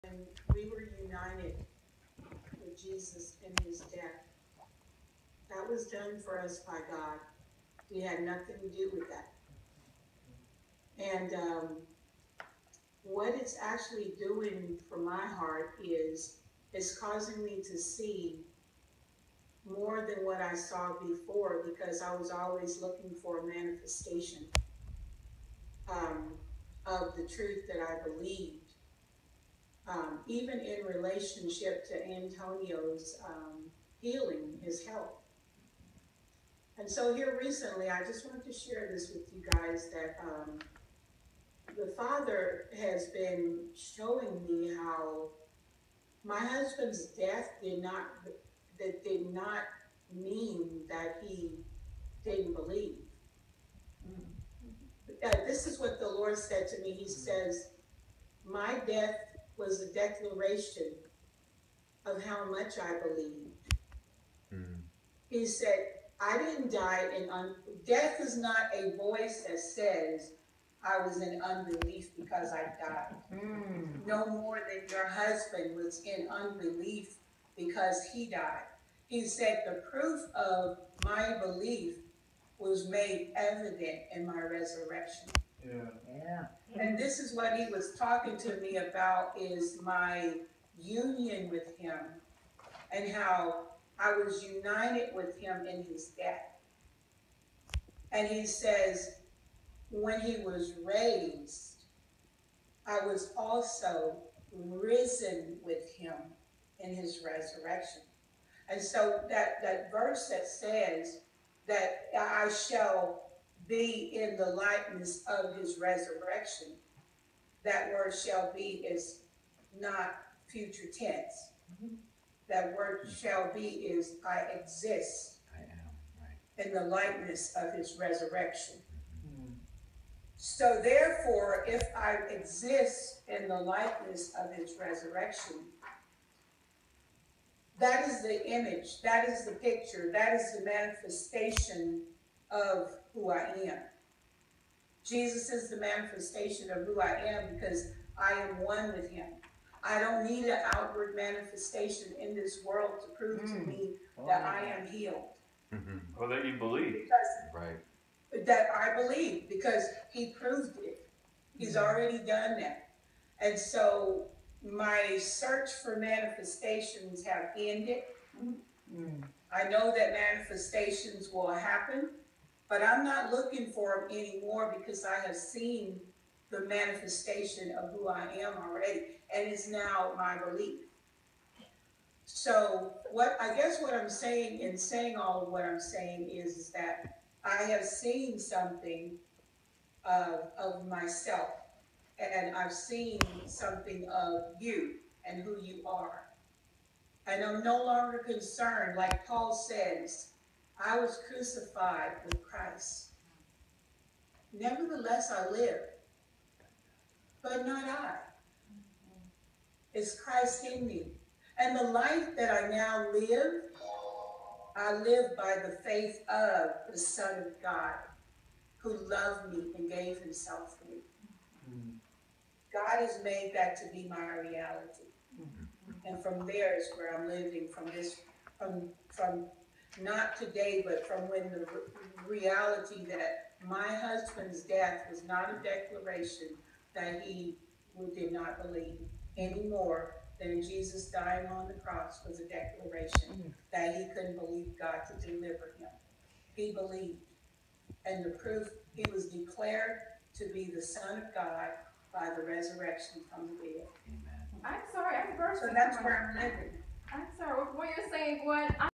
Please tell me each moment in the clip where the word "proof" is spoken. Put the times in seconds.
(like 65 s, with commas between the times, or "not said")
79 s, 248 s.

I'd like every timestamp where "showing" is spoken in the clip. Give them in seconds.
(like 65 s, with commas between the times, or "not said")
43 s.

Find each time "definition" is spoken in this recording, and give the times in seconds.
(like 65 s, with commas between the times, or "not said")
not said.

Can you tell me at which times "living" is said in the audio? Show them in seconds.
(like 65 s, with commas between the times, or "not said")
227 s, 256 s.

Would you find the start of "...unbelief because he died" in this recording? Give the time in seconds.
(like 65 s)
76 s.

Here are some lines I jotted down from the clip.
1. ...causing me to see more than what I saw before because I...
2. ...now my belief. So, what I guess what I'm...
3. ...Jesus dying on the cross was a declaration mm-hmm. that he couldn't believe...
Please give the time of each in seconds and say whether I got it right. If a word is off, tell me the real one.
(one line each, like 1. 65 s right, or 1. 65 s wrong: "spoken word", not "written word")
1. 16 s right
2. 179 s right
3. 240 s right.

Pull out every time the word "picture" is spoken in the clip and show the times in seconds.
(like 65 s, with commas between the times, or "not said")
139 s.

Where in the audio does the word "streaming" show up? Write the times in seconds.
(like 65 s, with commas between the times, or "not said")
not said.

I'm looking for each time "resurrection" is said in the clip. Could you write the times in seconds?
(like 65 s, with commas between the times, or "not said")
84 s, 107 s, 115 s, 127 s, 134 s, 252 s.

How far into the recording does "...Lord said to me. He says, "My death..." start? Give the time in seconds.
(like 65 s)
56 s.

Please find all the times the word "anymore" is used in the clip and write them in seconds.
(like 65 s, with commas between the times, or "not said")
174 s, 239 s.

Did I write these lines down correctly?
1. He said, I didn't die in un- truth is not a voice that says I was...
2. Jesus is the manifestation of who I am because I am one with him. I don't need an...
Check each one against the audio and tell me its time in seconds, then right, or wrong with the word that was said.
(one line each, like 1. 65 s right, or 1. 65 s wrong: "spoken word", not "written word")
1. 65 s wrong: "death", not "truth"
2. 145 s right.